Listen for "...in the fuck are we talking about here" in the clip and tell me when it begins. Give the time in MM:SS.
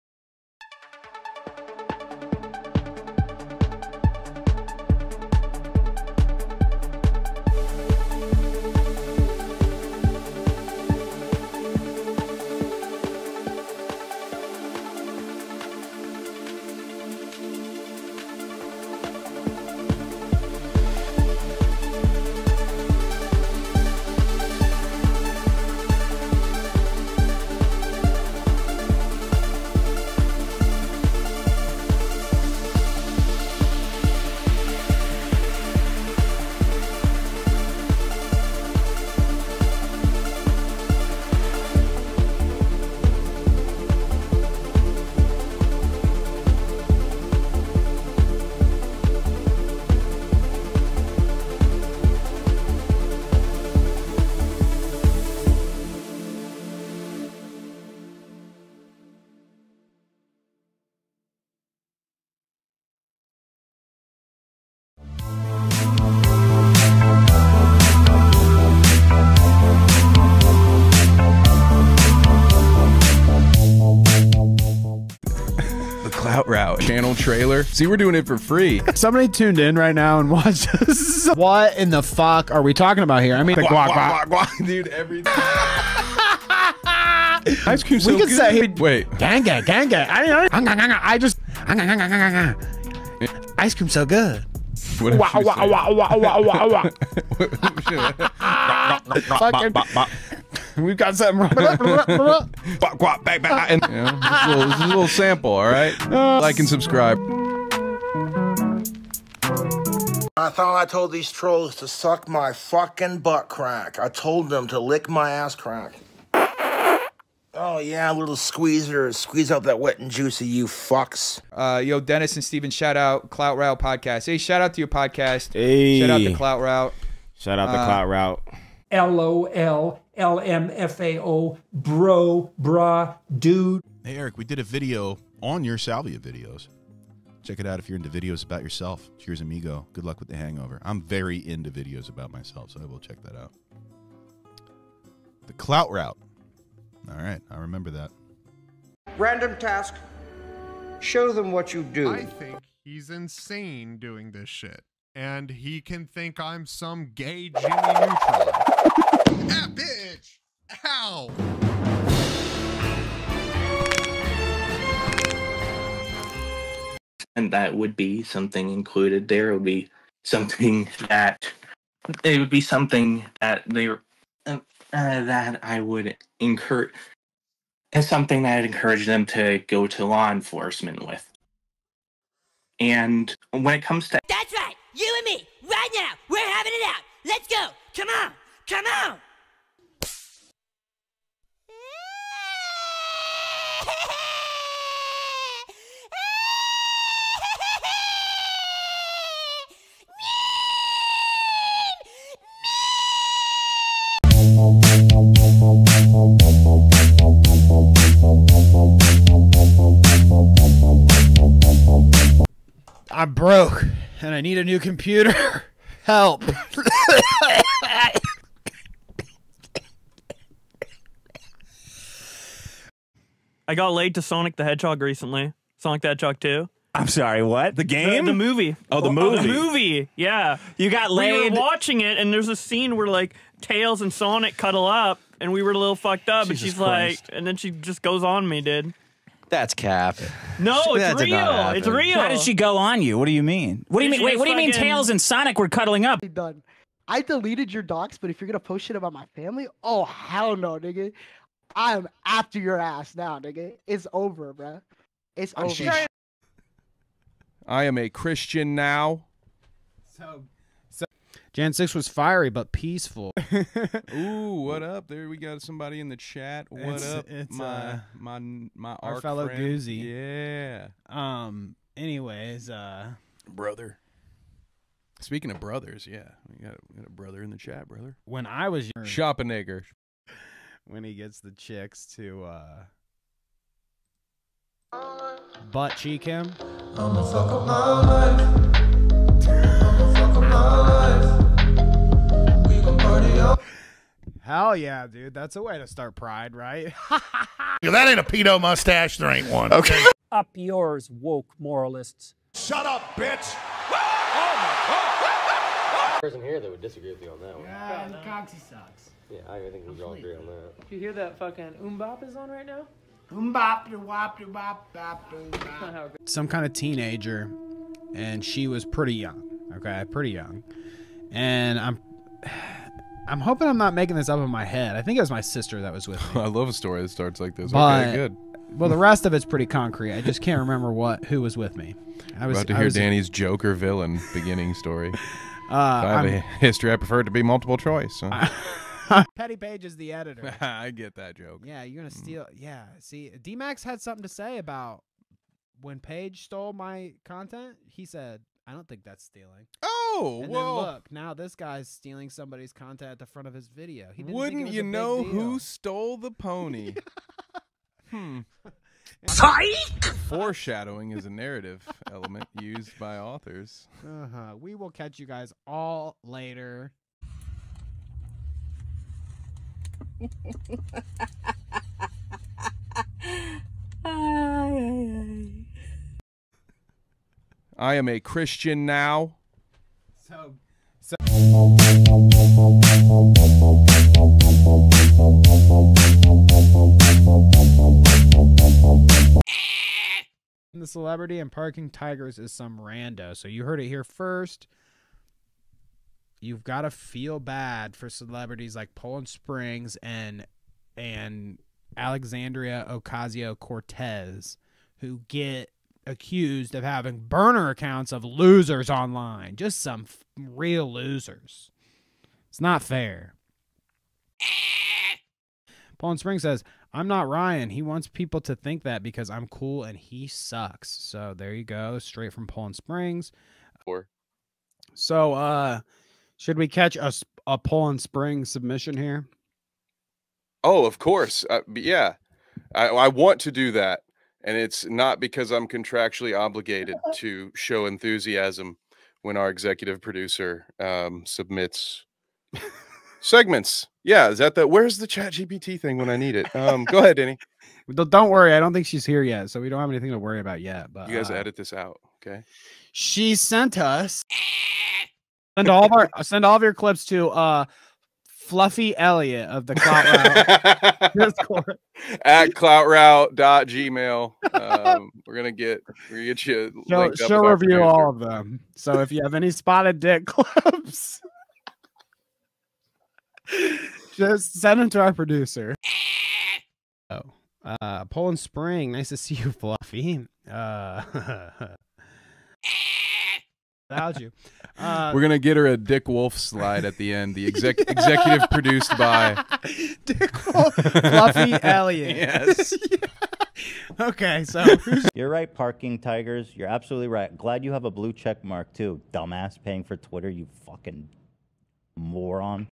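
01:21.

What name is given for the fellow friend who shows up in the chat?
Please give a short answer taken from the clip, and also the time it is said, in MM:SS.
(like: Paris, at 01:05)
Goozy, at 04:29.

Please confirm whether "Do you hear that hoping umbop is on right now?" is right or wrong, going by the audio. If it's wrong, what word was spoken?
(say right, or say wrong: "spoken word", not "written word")
wrong: "fucking", not "hoping".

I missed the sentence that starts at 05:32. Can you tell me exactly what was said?
I was about to hear was, Danny's Joker villain beginning story.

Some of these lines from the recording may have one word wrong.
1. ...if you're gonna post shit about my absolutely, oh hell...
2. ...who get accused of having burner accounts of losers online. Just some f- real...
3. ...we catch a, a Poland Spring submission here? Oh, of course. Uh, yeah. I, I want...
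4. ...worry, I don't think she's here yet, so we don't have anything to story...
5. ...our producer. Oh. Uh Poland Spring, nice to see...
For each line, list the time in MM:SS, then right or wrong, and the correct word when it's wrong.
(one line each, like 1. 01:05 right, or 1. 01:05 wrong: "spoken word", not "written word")
1. 04:08 wrong: "family", not "absolutely"
2. 06:44 right
3. 07:06 right
4. 07:28 wrong: "worry", not "story"
5. 07:54 right.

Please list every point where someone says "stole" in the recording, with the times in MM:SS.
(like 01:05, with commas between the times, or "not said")
05:46, 05:55.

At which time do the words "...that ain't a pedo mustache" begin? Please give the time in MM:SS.
04:57.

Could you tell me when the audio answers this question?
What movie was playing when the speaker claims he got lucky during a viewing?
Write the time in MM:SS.
03:45.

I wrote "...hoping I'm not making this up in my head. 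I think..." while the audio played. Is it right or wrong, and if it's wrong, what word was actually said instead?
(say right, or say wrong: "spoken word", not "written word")
right.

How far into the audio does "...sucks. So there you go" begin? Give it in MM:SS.
07:00.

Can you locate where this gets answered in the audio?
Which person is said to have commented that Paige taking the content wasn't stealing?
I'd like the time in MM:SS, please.
05:43.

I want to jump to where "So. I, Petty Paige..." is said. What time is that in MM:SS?
05:38.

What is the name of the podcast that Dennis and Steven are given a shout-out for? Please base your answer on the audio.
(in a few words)
Clout Route Podcast.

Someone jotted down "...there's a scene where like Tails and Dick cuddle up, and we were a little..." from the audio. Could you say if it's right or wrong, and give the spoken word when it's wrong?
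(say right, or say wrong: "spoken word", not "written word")
wrong: "Sonic", not "Dick".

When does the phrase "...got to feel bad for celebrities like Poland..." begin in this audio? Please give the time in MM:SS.
06:36.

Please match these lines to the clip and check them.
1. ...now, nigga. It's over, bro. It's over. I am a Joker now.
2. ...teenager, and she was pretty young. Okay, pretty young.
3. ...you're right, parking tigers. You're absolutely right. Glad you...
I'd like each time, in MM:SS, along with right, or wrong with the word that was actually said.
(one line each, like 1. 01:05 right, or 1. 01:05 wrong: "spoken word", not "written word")
1. 04:13 wrong: "Christian", not "Joker"
2. 05:16 right
3. 08:15 right.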